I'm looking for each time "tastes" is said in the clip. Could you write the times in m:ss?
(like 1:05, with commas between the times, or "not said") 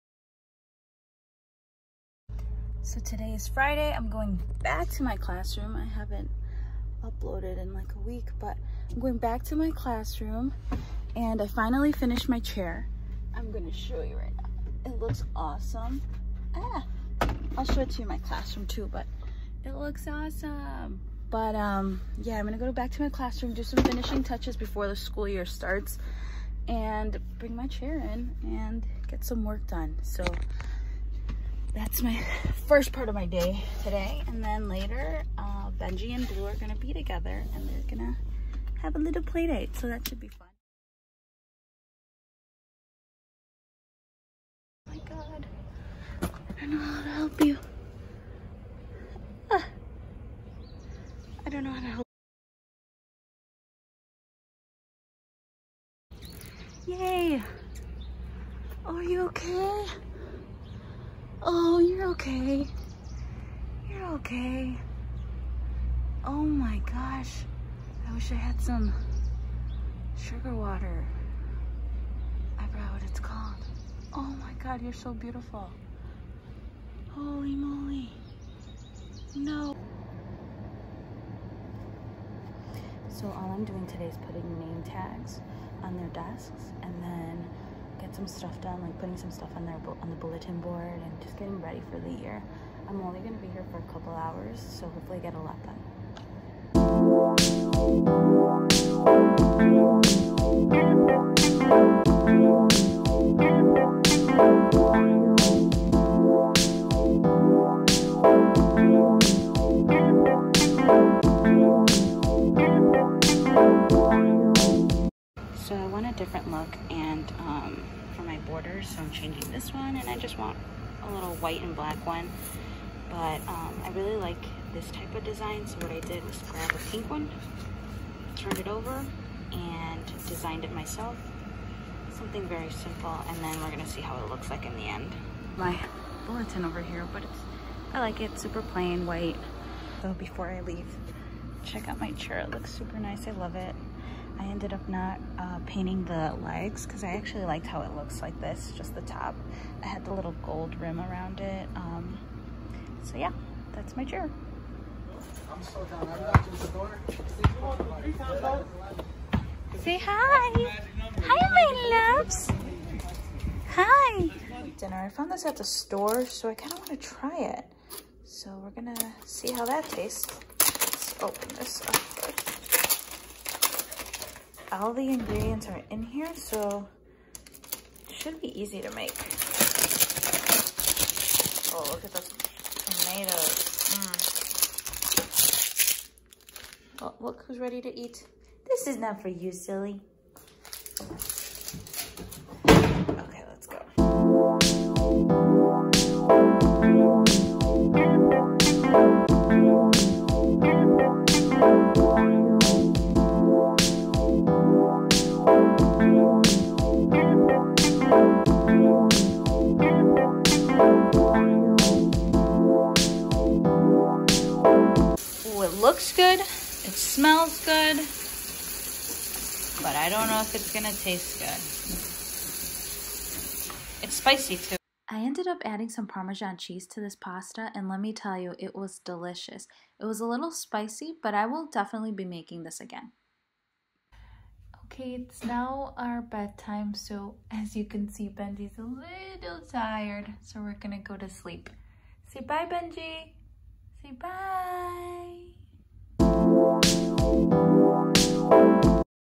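2:49, 3:40.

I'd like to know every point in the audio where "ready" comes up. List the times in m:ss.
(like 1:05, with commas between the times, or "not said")
1:31, 3:07.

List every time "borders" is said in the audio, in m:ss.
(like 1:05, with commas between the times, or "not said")
1:58.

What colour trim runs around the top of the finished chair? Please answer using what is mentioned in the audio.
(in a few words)
gold.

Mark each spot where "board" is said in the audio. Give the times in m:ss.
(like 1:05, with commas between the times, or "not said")
1:30.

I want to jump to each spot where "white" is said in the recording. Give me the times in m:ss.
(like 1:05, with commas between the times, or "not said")
2:01, 2:19.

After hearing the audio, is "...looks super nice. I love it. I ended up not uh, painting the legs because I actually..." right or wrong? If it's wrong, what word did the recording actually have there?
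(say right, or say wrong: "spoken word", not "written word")
right.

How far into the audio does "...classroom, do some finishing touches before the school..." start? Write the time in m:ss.
0:23.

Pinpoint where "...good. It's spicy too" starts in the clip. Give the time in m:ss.
3:41.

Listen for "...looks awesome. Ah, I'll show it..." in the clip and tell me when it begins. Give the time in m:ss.
0:14.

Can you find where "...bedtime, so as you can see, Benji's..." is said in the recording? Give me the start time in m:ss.
3:56.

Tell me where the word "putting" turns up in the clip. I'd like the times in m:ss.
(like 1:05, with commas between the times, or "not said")
1:24, 1:28.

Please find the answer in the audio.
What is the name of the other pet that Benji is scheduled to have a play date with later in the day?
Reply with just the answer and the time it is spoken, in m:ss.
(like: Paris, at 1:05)
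Blue, at 0:36.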